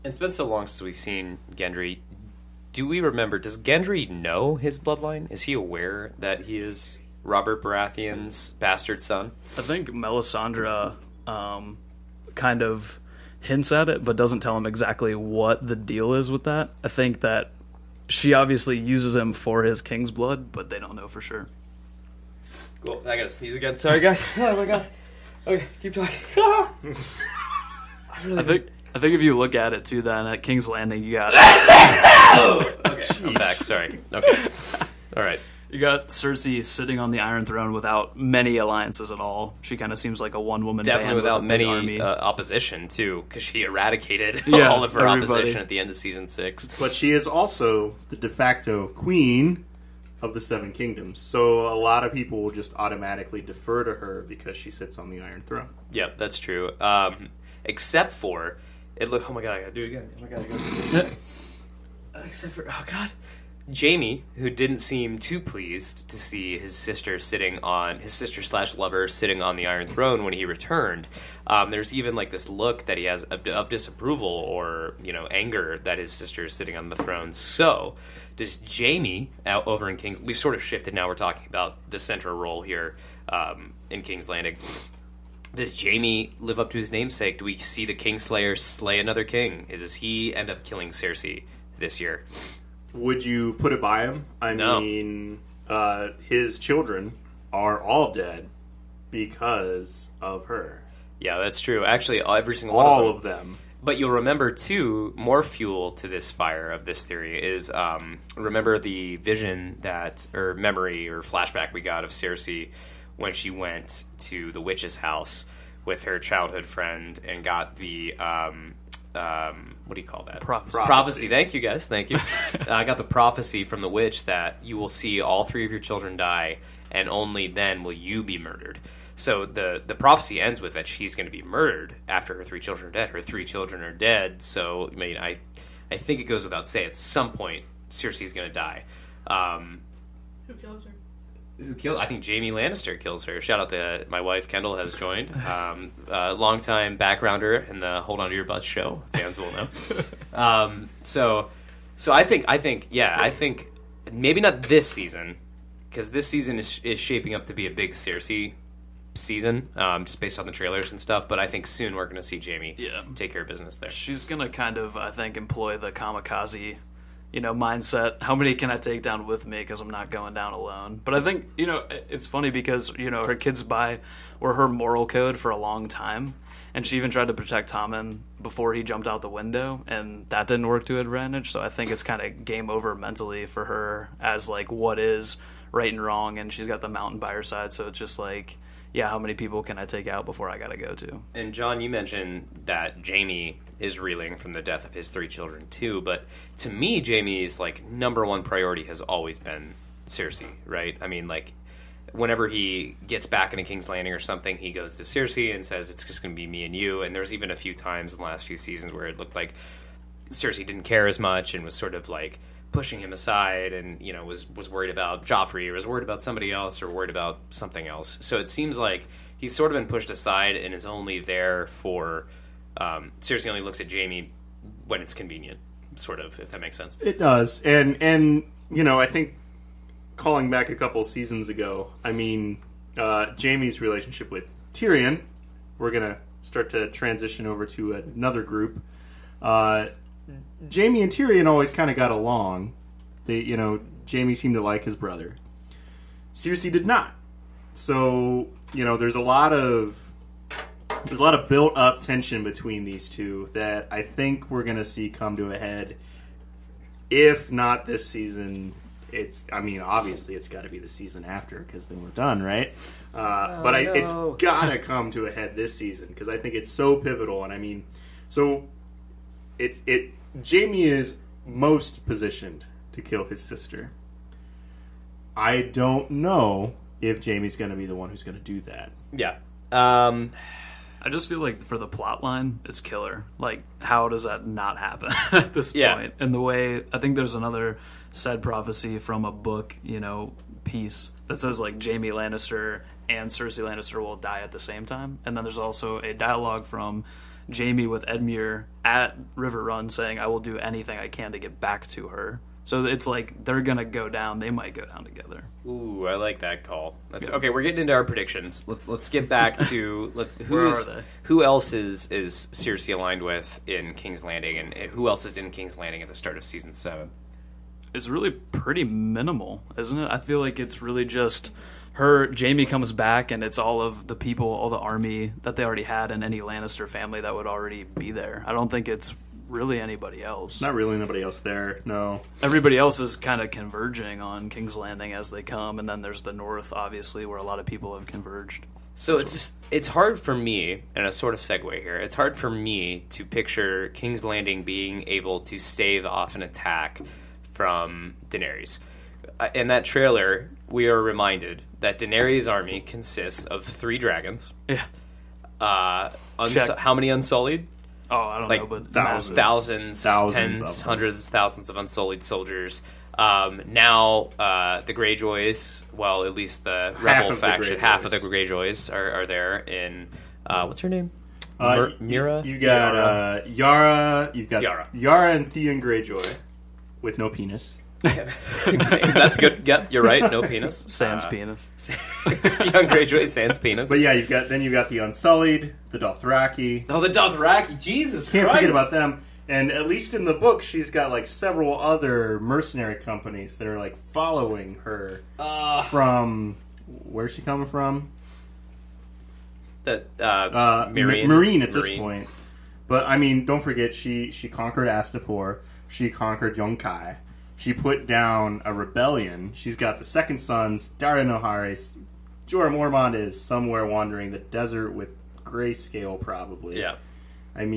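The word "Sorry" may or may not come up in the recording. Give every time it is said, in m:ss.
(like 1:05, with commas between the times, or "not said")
0:23, 0:33.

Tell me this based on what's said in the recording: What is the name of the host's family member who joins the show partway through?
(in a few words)
Kendall.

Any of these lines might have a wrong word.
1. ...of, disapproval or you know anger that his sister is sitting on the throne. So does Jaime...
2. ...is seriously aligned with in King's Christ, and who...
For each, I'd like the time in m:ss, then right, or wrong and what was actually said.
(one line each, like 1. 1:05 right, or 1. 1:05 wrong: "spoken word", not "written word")
1. 1:13 right
2. 5:12 wrong: "Landing", not "Christ".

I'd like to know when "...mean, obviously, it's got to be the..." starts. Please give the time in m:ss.
4:19.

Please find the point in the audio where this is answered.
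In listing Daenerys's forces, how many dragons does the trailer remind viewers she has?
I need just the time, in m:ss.
5:53.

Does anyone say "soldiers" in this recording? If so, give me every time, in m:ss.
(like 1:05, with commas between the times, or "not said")
6:02.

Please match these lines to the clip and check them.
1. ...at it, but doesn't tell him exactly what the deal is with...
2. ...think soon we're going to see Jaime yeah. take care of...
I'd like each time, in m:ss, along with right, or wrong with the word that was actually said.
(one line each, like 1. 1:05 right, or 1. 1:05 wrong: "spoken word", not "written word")
1. 0:13 right
2. 2:41 right.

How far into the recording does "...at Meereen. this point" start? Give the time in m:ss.
6:41.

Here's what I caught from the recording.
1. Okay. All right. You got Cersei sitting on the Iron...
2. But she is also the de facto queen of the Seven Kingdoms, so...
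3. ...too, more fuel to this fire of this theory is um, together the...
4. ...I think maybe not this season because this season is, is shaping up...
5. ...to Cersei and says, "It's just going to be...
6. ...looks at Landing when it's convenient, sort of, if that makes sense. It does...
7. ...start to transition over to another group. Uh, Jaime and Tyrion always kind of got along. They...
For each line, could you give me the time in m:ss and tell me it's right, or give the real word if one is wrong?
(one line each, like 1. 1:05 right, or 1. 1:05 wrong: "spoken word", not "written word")
1. 0:34 right
2. 0:46 right
3. 1:44 wrong: "remember", not "together"
4. 2:33 right
5. 3:24 right
6. 3:43 wrong: "Jaime", not "Landing"
7. 3:56 right.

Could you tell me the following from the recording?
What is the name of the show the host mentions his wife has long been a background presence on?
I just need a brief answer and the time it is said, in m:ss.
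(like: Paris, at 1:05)
Hold On to Your Butts, at 2:28.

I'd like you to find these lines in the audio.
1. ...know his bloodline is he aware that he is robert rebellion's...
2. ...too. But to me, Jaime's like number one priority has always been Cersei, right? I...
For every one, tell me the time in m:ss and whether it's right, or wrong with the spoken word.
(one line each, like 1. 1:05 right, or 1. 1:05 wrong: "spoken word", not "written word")
1. 0:04 wrong: "baratheon", not "rebellion"
2. 3:15 right.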